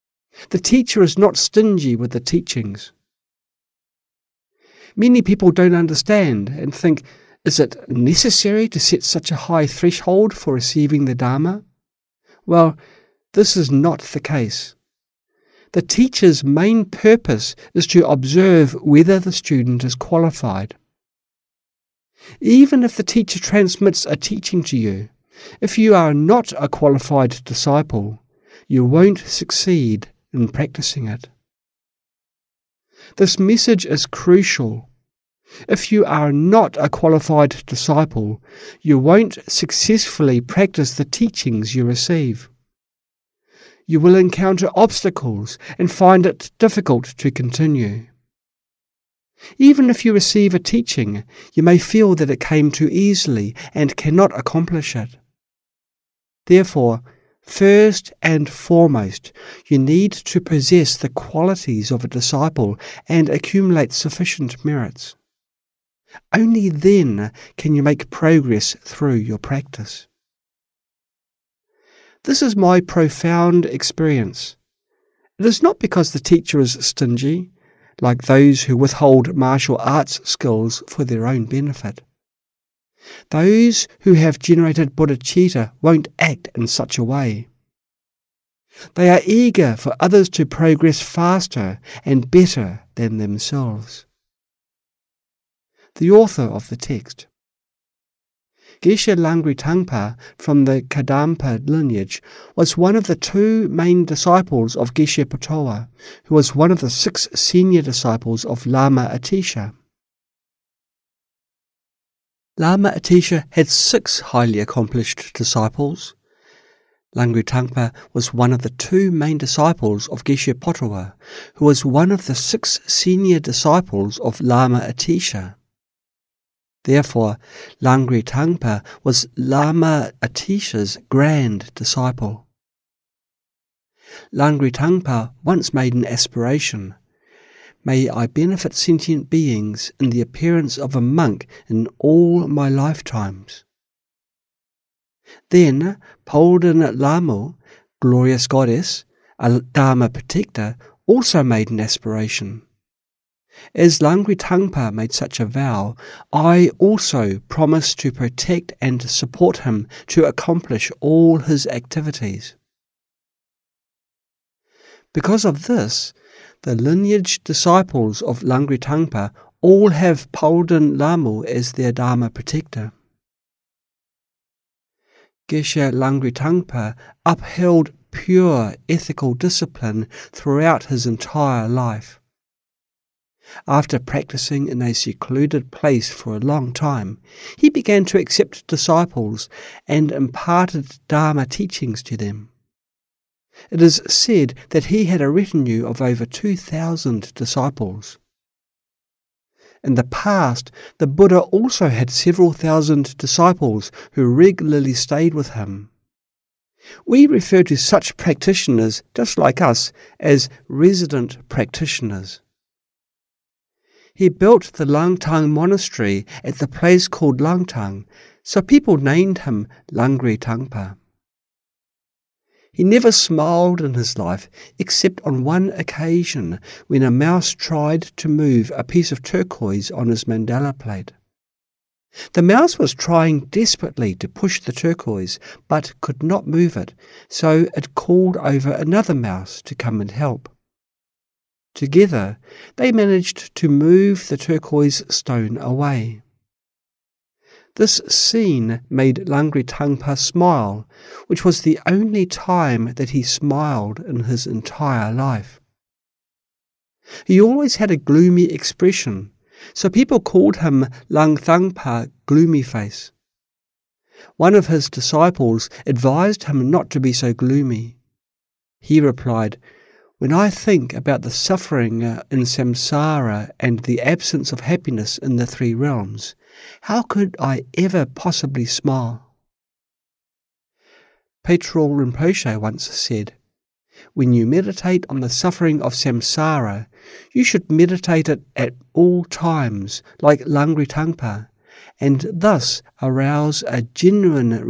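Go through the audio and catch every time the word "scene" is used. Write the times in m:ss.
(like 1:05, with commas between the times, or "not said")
4:08.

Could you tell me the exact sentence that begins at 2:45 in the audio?
Because of this, the lineage disciples of Langri Tangpa all have Palden Lhamo as their Dharma protector.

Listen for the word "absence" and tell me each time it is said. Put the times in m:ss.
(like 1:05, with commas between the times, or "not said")
4:34.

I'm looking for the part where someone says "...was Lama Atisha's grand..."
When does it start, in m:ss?
2:09.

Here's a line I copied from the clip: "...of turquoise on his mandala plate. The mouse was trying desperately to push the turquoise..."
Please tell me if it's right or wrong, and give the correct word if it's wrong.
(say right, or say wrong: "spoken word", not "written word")
right.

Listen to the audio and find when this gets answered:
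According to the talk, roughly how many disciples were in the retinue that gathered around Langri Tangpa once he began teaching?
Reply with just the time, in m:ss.
3:16.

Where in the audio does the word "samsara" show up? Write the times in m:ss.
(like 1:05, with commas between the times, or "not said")
4:32, 4:45.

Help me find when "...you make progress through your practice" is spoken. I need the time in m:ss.
1:07.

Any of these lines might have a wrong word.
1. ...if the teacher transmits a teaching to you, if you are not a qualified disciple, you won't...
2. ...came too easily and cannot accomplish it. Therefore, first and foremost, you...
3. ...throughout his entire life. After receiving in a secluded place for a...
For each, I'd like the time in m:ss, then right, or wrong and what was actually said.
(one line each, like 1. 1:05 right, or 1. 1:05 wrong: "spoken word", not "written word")
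1. 0:22 right
2. 0:52 right
3. 3:00 wrong: "practicing", not "receiving".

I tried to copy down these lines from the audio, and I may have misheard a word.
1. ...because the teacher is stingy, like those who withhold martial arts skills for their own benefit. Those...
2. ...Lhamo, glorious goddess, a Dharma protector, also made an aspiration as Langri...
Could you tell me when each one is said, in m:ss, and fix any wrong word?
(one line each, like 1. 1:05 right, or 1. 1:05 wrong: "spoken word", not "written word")
1. 1:15 right
2. 2:26 right.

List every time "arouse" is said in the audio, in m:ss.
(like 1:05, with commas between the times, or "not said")
4:53.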